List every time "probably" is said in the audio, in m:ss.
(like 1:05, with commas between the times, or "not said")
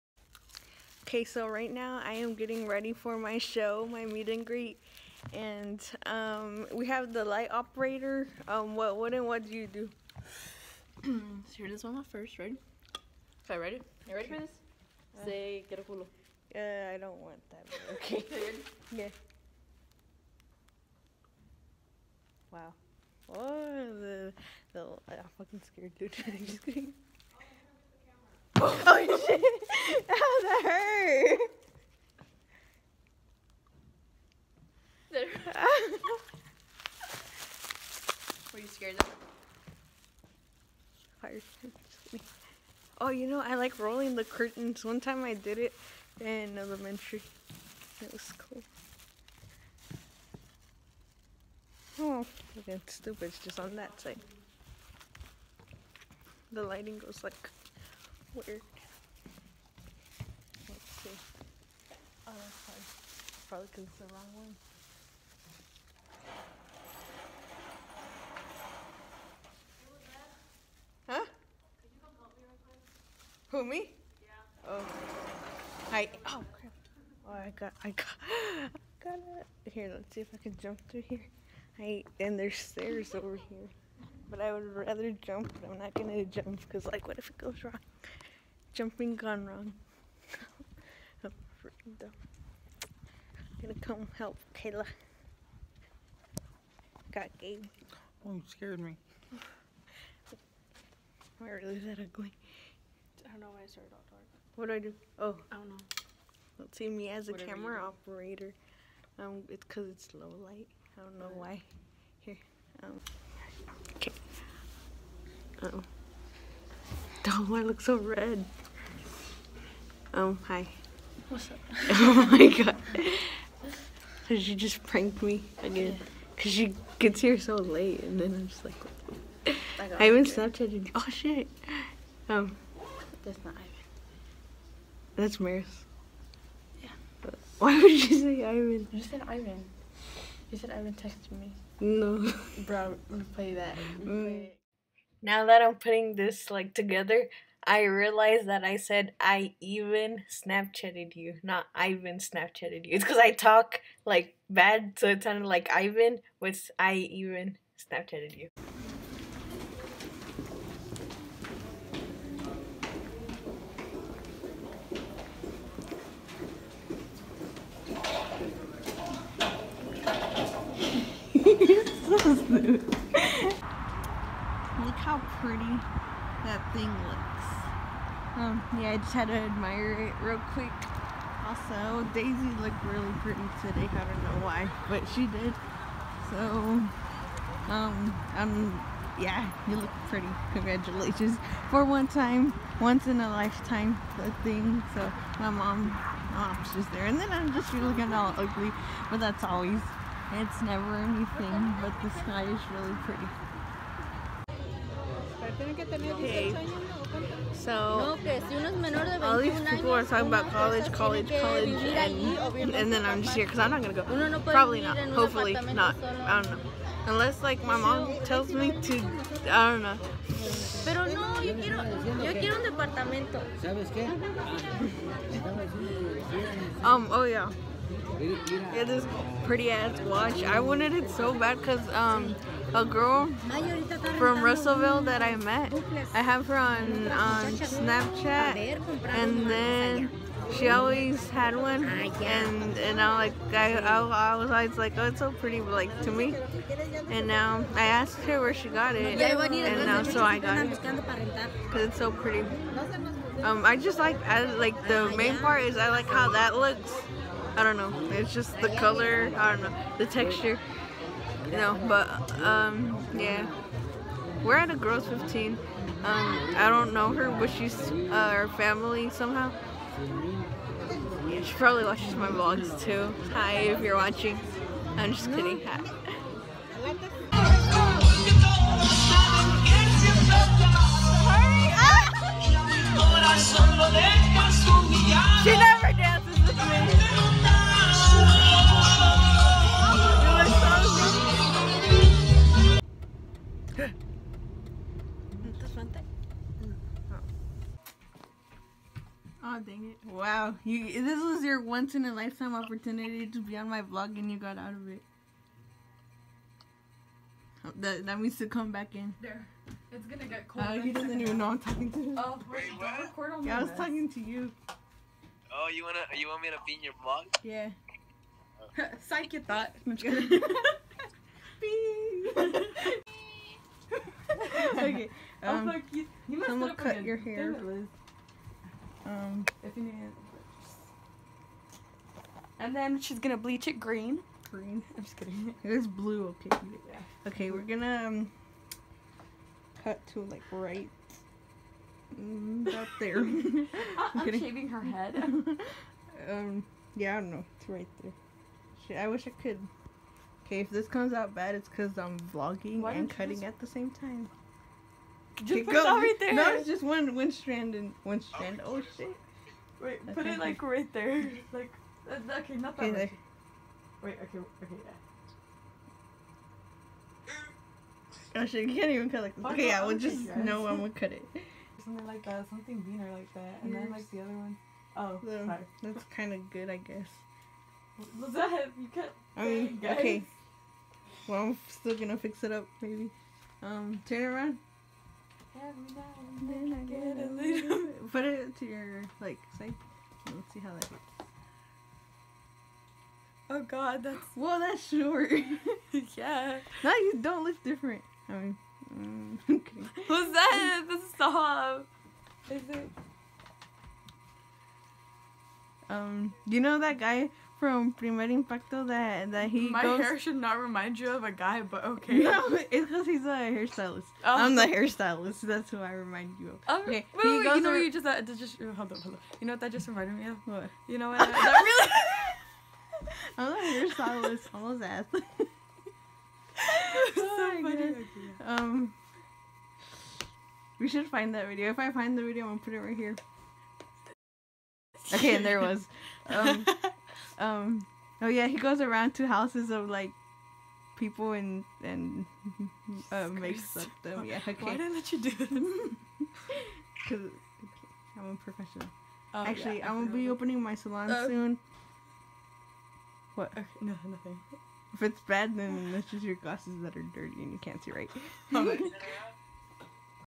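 1:03, 3:34, 4:31.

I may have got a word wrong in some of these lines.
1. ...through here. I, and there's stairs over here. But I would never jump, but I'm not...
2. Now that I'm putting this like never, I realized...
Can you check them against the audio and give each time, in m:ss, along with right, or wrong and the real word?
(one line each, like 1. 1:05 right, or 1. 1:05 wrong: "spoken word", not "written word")
1. 1:20 wrong: "rather", not "never"
2. 2:25 wrong: "together", not "never".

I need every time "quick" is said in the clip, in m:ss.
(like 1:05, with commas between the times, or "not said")
3:00.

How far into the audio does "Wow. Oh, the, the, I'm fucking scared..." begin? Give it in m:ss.
0:22.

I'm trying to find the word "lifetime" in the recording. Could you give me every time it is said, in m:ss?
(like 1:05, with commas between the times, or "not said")
3:13, 5:02.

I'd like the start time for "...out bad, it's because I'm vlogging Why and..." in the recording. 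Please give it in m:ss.
5:51.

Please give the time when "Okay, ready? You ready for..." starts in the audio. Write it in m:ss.
0:13.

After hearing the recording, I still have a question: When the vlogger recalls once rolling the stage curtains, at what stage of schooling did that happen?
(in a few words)
Elementary.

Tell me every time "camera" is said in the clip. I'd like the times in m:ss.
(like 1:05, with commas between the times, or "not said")
1:47.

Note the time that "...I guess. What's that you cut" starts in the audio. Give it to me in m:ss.
6:16.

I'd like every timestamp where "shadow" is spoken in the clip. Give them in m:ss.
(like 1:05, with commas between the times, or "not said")
not said.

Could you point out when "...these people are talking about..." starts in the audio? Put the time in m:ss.
3:29.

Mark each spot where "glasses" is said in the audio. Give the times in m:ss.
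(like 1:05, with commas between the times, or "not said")
7:36.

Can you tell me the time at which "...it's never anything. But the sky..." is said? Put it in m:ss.
3:20.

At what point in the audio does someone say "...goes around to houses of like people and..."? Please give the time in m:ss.
7:18.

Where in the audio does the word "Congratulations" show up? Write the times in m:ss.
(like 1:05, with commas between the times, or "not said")
3:10.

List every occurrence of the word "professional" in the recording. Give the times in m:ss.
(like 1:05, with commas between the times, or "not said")
7:28.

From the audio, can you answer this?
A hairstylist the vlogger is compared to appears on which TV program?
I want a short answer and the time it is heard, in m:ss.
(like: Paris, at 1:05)
Primer Impacto, at 6:47.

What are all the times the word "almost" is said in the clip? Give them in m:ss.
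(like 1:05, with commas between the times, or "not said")
7:04.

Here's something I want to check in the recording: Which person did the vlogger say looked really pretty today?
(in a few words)
Daisy.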